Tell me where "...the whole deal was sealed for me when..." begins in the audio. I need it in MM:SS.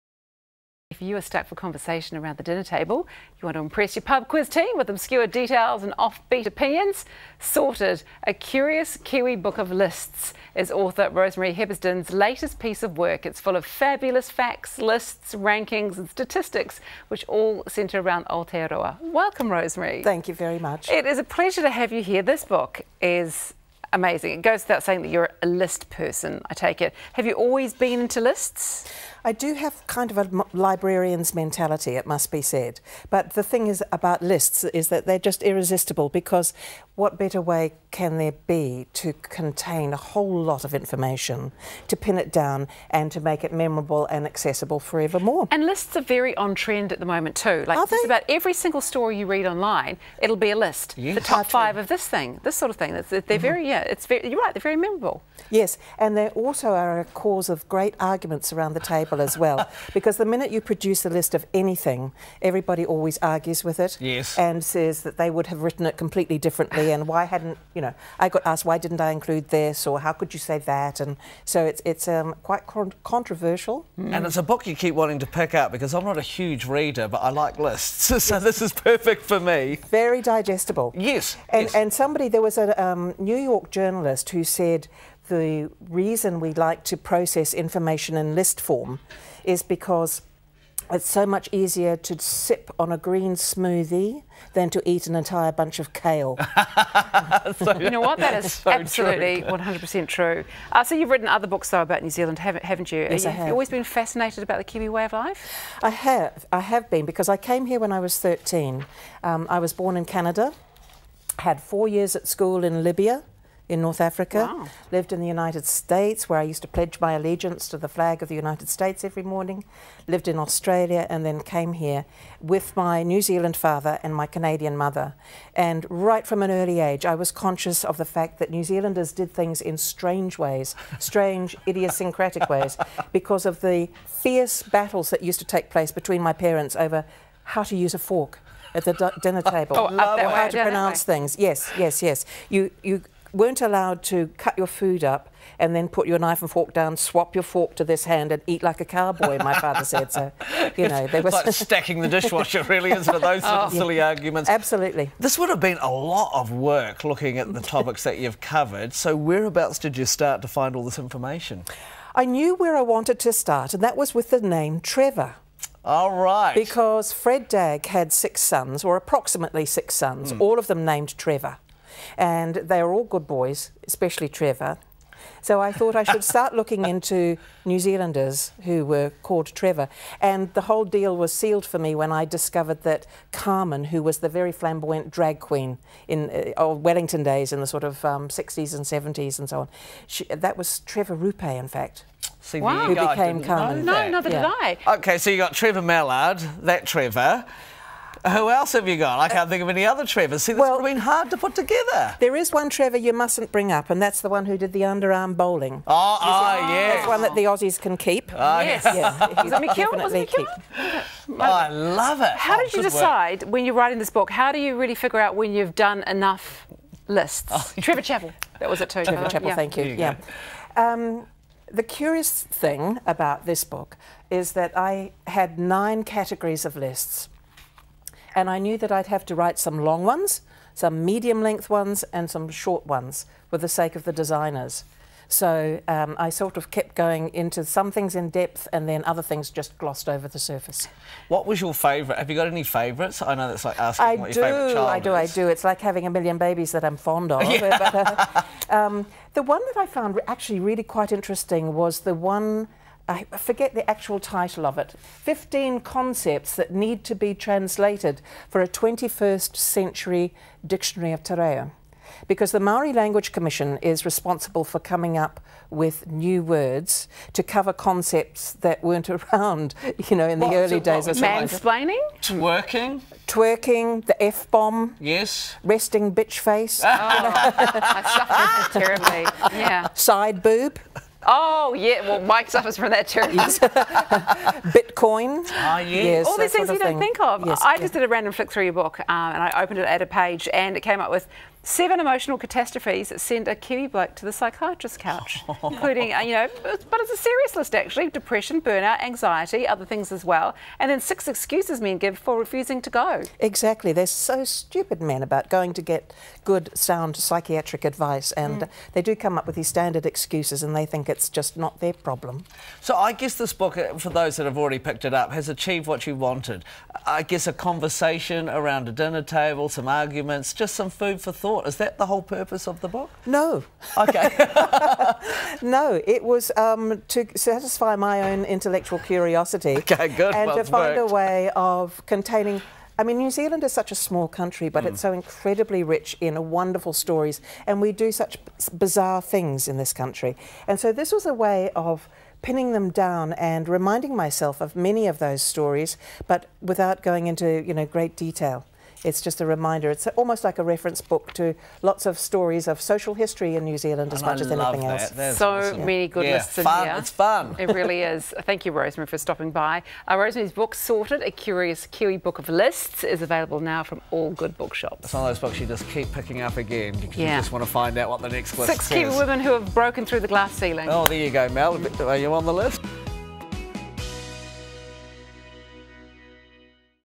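03:00.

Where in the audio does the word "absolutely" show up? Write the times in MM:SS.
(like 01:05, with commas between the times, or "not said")
01:38, 02:34.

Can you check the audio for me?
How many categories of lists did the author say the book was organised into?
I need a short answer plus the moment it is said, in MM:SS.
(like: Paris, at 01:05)
9, at 03:45.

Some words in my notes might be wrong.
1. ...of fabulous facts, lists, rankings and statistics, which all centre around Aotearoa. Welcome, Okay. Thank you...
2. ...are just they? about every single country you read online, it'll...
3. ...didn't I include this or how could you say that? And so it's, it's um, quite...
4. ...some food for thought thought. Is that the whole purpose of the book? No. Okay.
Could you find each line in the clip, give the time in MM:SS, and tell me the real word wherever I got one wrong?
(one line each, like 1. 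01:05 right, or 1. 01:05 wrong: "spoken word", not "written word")
1. 00:13 wrong: "Rosemary", not "Okay"
2. 00:47 wrong: "story", not "country"
3. 01:08 right
4. 05:20 right.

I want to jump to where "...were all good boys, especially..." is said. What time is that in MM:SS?
02:52.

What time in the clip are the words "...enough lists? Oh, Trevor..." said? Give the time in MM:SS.
03:36.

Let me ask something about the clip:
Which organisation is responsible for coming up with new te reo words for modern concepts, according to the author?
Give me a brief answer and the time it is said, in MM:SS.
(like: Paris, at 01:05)
Maori Language Commission, at 04:22.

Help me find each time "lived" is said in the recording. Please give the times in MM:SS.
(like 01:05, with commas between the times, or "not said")
01:54, 02:00.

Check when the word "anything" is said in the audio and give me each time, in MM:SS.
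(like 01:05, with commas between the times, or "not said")
01:01, 05:54.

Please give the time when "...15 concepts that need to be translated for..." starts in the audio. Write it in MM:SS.
04:15.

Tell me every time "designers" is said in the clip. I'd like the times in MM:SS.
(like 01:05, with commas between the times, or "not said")
03:54.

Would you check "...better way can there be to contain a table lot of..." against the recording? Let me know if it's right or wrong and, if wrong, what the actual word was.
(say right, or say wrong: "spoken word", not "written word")
wrong: "whole", not "table".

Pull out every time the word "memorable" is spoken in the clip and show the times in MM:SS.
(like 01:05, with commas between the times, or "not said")
00:43, 00:54.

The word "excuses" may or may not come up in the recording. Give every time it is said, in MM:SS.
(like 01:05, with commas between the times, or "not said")
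05:01, 05:10.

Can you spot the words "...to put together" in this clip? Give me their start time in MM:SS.
03:21.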